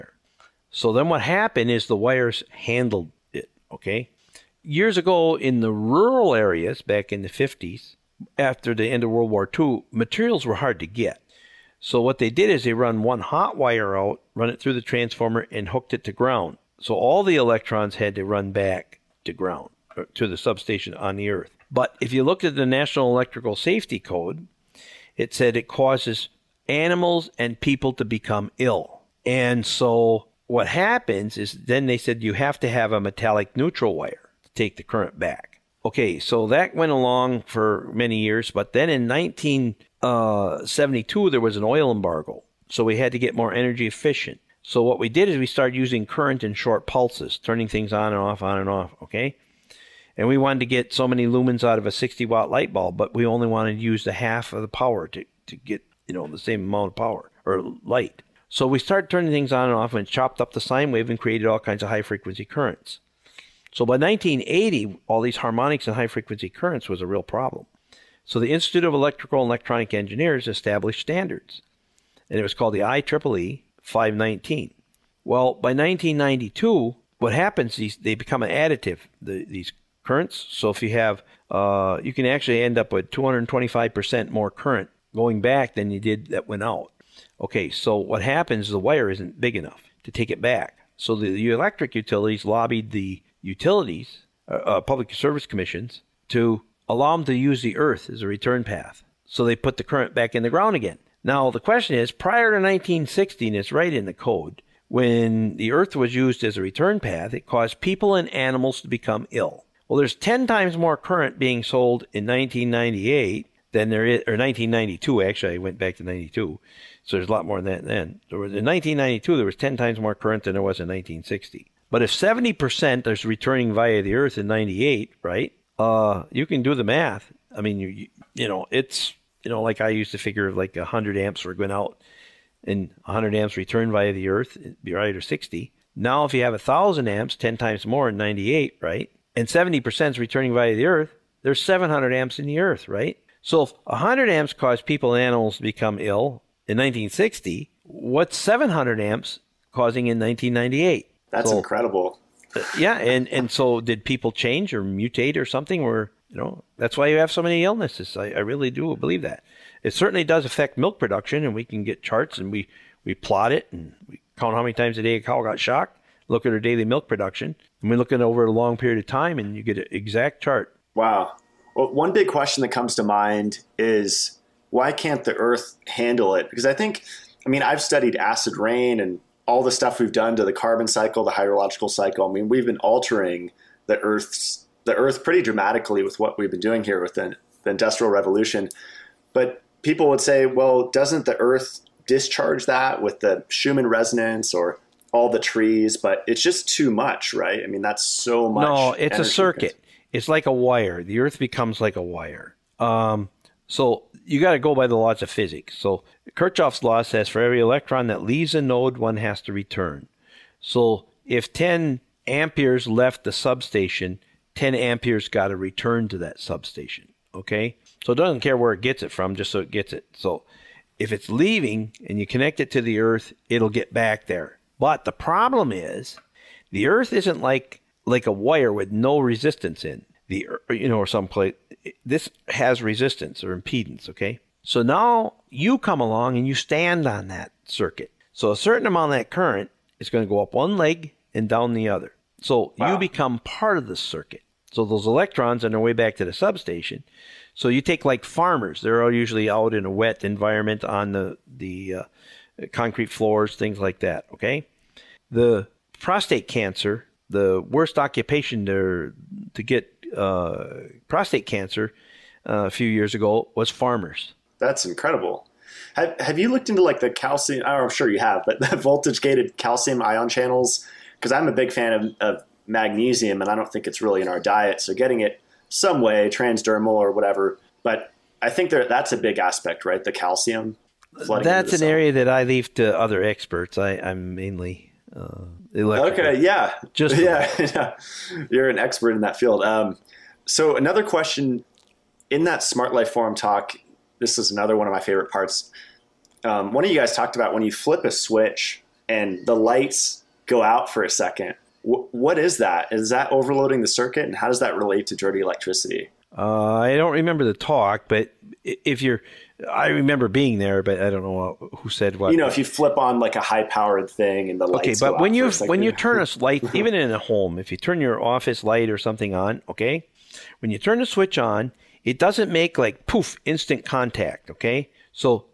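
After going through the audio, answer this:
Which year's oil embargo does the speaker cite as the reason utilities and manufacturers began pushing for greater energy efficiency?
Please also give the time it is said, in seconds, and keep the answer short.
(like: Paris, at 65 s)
1972, at 39 s.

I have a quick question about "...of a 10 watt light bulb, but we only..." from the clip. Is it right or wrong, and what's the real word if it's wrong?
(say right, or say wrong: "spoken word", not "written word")
wrong: "60", not "10".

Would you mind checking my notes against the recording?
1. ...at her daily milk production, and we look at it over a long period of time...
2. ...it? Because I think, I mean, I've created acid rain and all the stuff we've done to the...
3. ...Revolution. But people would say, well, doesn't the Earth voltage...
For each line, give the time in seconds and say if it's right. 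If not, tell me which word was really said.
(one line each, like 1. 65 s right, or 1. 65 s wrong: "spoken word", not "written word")
1. 166 s right
2. 176 s wrong: "studied", not "created"
3. 188 s wrong: "discharge", not "voltage".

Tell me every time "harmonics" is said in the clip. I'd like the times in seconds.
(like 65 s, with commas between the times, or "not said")
65 s.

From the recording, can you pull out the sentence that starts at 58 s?
So we started turning things on and off and chopped up the sine wave and created all kinds of high frequency currents.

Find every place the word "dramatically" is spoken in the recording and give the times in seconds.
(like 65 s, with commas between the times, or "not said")
185 s.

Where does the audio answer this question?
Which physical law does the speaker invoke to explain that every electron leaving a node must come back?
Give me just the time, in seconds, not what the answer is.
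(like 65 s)
206 s.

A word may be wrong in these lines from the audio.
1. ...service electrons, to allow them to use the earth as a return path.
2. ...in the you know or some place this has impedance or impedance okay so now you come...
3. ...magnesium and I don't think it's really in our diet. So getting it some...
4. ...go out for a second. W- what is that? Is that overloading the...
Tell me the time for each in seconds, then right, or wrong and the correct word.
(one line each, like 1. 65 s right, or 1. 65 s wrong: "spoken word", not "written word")
1. 95 s wrong: "commissions", not "electrons"
2. 229 s wrong: "resistance", not "impedance"
3. 272 s right
4. 300 s right.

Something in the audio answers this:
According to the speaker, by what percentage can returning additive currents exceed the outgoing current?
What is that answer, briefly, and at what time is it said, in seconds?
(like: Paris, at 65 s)
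225%, at 83 s.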